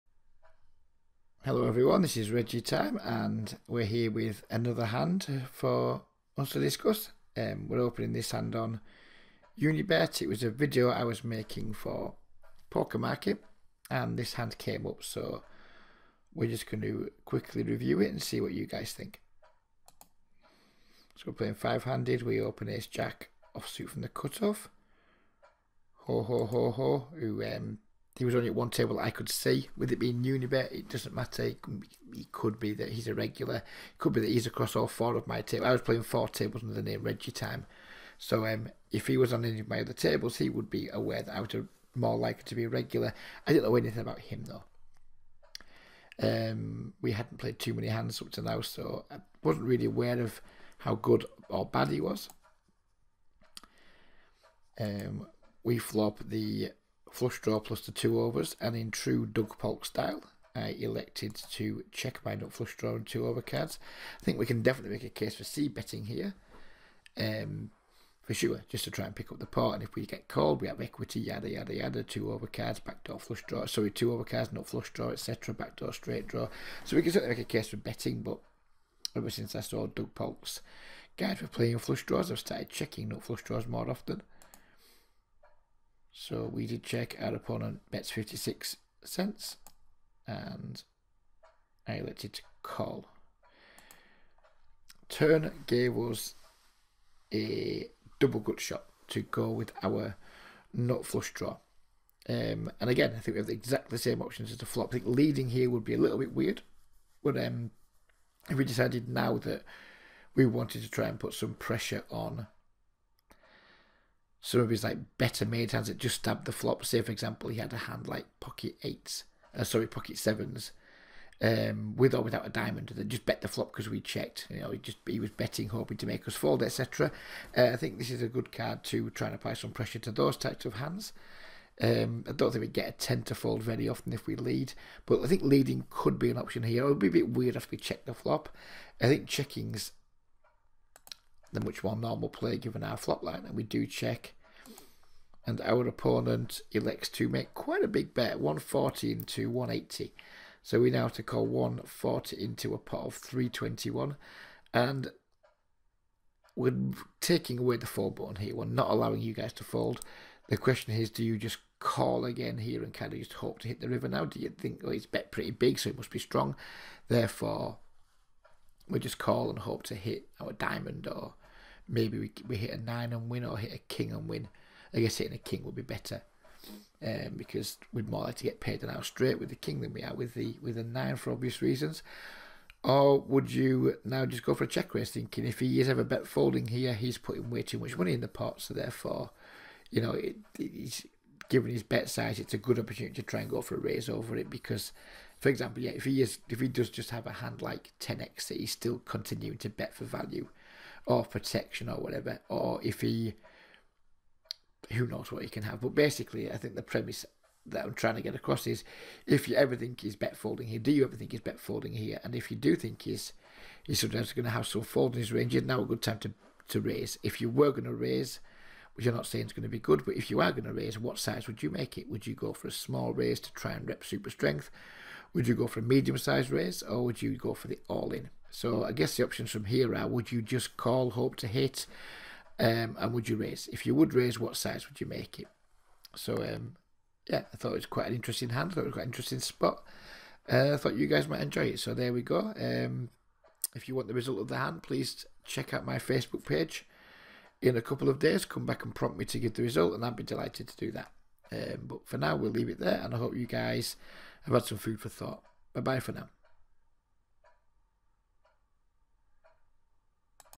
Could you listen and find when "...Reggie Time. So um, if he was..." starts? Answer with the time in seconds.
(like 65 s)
37 s.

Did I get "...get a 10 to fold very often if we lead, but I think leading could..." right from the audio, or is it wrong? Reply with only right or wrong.
right.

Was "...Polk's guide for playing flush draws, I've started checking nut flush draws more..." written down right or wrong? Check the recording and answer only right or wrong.
right.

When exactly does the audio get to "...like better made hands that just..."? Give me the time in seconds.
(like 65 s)
114 s.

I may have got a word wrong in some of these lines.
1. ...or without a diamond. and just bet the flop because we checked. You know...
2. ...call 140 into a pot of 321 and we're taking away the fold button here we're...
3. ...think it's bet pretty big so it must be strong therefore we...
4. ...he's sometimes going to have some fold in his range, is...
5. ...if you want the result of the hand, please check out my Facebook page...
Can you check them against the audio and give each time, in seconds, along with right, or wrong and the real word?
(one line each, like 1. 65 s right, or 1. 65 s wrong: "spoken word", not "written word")
1. 122 s right
2. 151 s right
3. 164 s right
4. 213 s right
5. 243 s right.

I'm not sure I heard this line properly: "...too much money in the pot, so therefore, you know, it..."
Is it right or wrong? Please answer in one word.
right.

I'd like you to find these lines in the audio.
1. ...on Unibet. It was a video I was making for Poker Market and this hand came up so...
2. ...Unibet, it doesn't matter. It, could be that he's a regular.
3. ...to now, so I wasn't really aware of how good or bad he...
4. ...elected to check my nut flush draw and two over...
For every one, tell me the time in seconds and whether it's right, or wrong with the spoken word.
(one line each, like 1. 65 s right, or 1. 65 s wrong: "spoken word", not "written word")
1. 8 s right
2. 30 s right
3. 48 s right
4. 60 s right.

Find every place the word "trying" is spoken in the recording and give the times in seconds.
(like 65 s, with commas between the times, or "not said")
207 s.